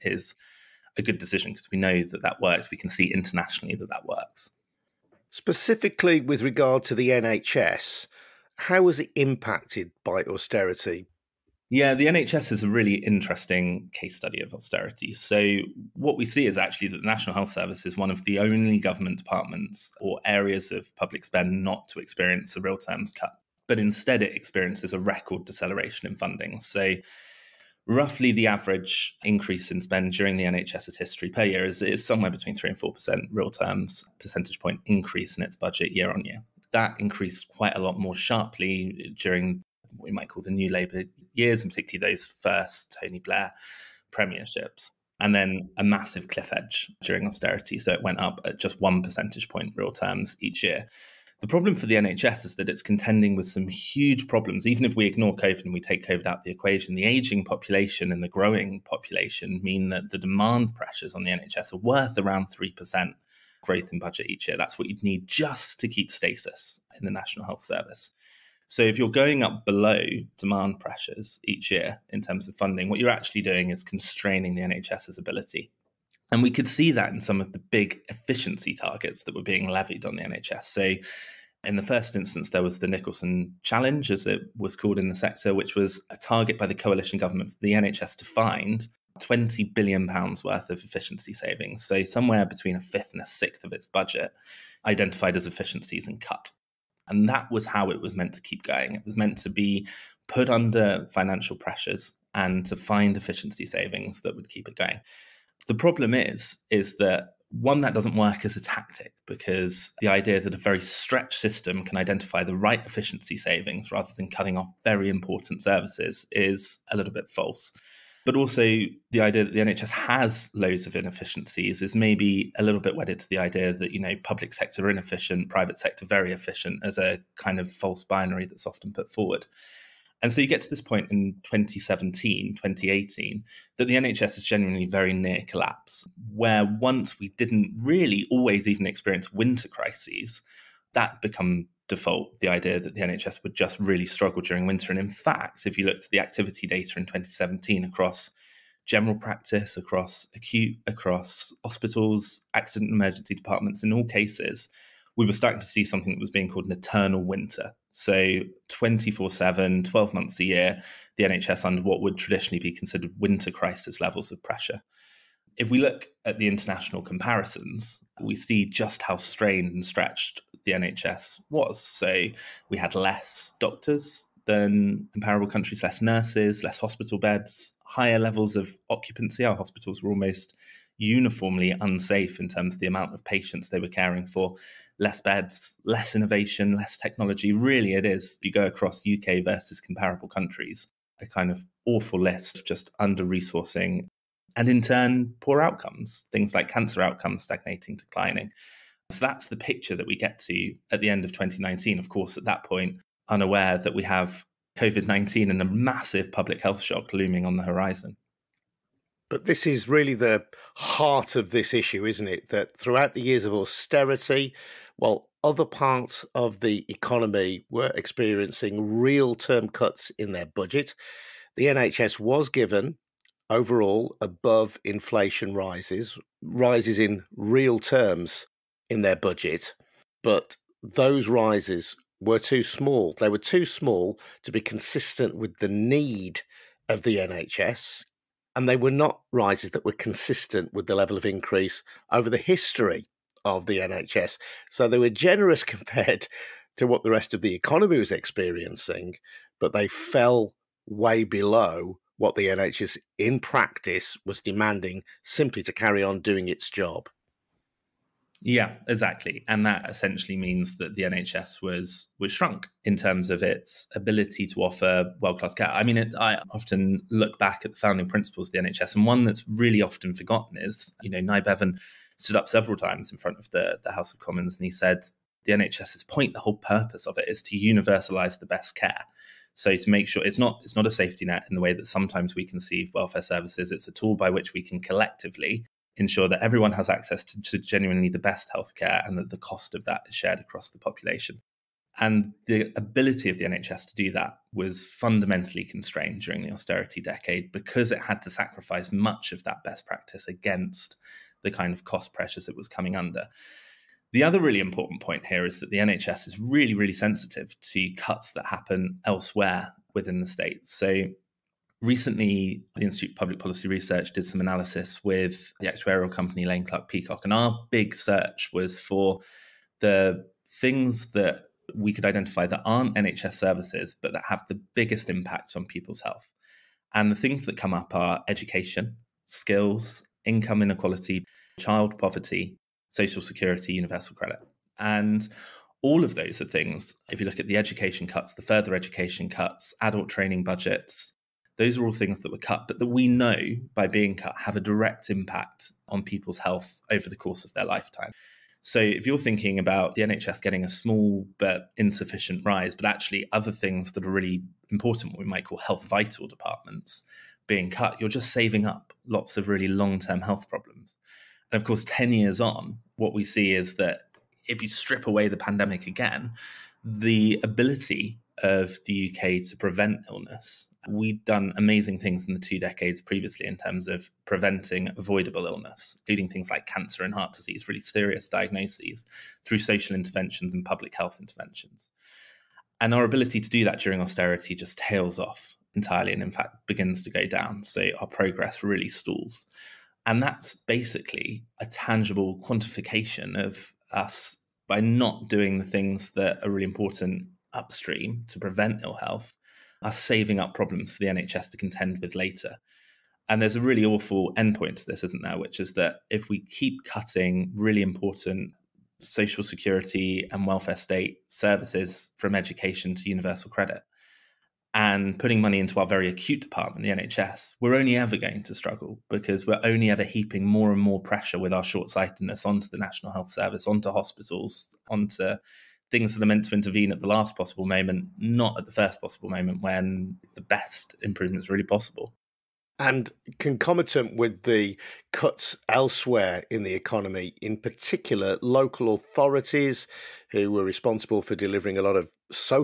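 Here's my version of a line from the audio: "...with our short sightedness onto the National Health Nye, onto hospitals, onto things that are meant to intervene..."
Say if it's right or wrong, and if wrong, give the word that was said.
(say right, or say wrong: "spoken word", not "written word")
wrong: "Service", not "Nye".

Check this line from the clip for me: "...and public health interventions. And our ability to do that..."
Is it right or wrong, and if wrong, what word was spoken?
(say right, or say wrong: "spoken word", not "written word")
right.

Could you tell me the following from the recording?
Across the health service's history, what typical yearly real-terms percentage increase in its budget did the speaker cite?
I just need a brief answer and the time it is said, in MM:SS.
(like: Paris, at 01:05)
3 to 4%, at 00:32.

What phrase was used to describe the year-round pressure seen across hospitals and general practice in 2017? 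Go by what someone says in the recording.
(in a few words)
eternal winter.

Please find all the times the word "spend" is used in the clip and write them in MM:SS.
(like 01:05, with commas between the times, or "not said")
00:21, 00:29.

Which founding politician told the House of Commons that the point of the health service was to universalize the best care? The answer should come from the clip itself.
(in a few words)
Nye Bevan.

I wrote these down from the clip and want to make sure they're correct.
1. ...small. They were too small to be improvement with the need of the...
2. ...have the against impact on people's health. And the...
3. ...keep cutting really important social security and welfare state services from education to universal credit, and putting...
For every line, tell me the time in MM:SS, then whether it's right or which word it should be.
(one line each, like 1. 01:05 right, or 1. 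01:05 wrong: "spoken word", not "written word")
1. 03:52 wrong: "consistent", not "improvement"
2. 05:24 wrong: "biggest", not "against"
3. 06:46 right.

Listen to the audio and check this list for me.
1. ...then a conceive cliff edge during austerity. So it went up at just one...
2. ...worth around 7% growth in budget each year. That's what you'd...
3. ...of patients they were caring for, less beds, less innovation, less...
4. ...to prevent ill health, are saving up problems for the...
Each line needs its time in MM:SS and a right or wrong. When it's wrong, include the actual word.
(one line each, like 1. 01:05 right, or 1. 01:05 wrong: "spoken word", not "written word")
1. 00:45 wrong: "massive", not "conceive"
2. 01:01 wrong: "3", not "7"
3. 03:03 right
4. 06:38 right.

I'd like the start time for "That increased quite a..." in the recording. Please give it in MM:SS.
00:36.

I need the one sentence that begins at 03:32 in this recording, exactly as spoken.
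That throughout the years of austerity, while other parts of the economy were experiencing real term cuts in their budget.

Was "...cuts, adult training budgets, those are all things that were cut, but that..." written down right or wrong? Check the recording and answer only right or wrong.
right.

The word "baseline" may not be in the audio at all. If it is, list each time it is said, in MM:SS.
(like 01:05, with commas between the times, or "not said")
not said.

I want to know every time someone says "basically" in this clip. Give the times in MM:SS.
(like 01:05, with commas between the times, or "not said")
06:30.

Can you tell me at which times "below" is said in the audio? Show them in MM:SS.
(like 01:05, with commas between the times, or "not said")
01:09, 04:11.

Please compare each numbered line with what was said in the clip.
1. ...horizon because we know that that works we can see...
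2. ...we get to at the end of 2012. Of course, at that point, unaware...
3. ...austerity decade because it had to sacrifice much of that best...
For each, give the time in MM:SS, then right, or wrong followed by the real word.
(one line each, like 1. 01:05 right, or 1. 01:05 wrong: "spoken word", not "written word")
1. 00:01 wrong: "decision", not "horizon"
2. 03:20 wrong: "2019", not "2012"
3. 04:56 right.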